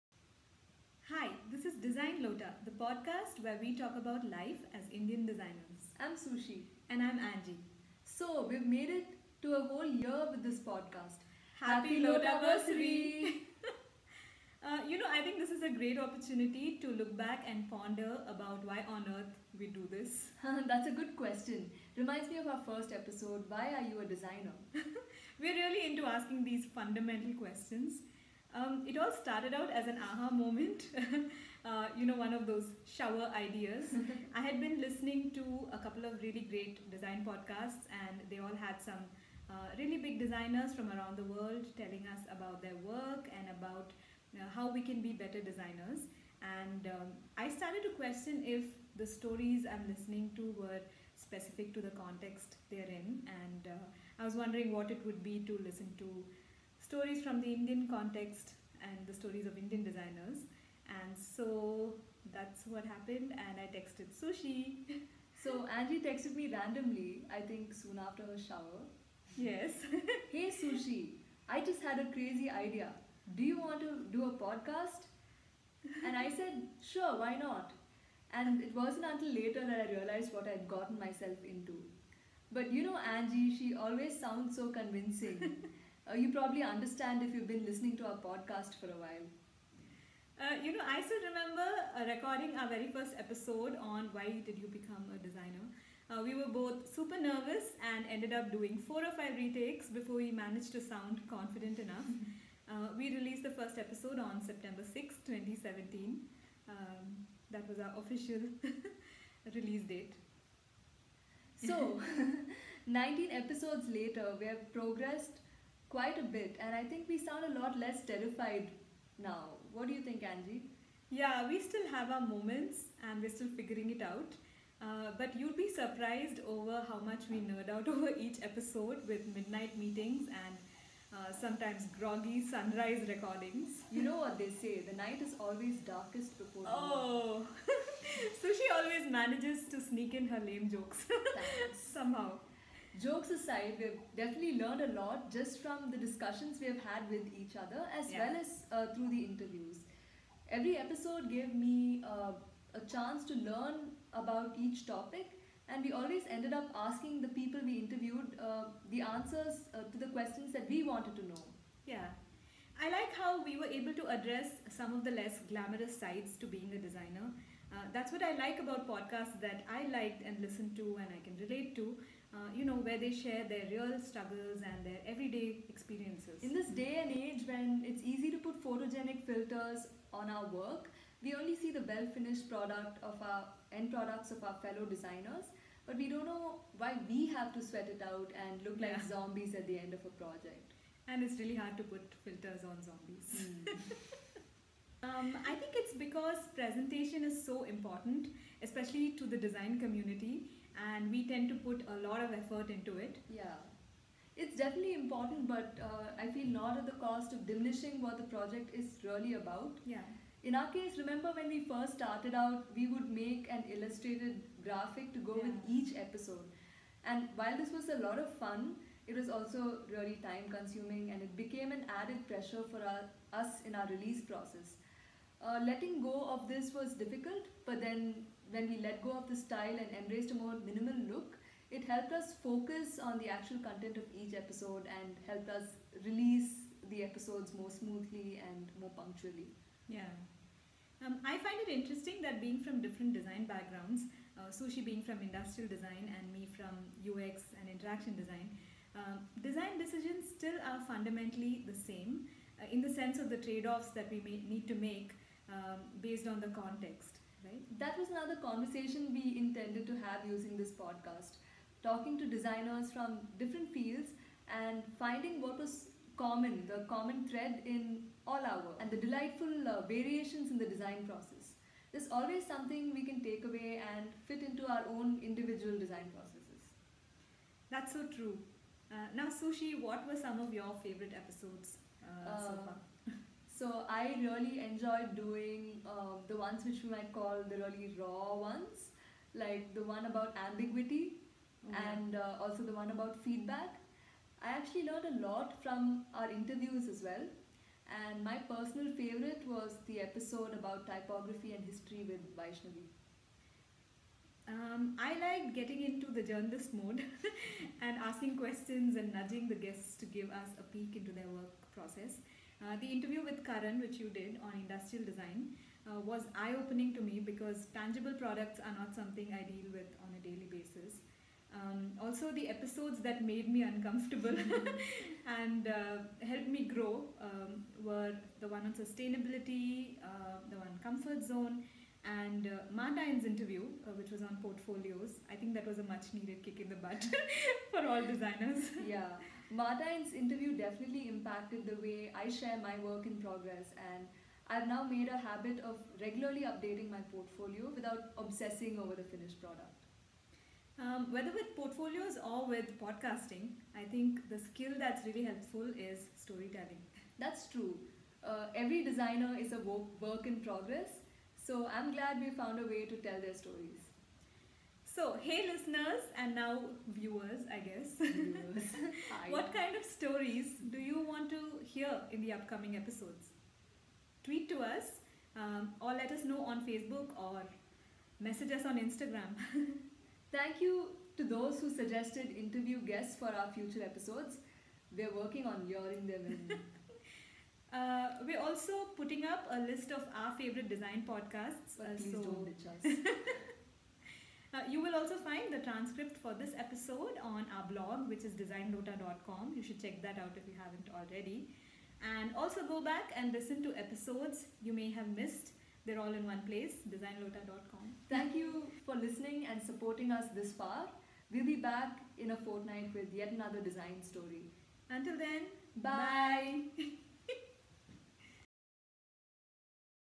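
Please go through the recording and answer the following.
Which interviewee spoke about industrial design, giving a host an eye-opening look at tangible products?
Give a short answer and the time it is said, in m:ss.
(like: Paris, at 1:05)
Karan, at 5:13.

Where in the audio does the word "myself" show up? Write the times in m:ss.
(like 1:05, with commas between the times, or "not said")
1:20.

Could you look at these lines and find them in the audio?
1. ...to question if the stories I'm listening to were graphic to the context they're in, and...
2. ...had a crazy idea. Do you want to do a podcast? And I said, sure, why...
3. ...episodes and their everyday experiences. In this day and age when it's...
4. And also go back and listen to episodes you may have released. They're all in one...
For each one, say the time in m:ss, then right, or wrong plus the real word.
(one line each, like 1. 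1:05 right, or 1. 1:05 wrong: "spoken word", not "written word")
1. 0:47 wrong: "specific", not "graphic"
2. 1:11 right
3. 2:53 wrong: "struggles", not "episodes"
4. 6:42 wrong: "missed", not "released".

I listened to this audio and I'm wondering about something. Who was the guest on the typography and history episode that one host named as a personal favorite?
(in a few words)
Vaishnavi.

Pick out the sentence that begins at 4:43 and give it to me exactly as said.
So I really enjoyed doing um, the ones which we might call the really raw ones, like the one about ambiguity mm-hmm.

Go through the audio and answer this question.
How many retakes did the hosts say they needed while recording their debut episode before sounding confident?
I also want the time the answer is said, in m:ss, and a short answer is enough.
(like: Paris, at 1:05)
four or five, at 1:38.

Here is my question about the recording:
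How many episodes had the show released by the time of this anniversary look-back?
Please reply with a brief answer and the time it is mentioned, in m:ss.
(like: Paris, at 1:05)
19, at 1:52.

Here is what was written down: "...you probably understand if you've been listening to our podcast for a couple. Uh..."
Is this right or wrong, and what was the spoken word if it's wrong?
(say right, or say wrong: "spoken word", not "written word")
wrong: "while", not "couple".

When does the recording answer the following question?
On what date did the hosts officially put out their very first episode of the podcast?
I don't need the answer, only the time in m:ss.
1:44.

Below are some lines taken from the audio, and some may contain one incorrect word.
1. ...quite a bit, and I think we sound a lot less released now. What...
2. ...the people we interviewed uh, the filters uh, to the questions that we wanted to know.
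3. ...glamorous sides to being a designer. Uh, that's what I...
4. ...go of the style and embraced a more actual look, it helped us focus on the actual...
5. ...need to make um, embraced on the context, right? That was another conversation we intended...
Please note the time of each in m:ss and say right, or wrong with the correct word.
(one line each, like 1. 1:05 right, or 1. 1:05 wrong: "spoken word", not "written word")
1. 1:55 wrong: "terrified", not "released"
2. 2:37 wrong: "answers", not "filters"
3. 2:45 right
4. 3:49 wrong: "minimal", not "actual"
5. 4:14 wrong: "based", not "embraced".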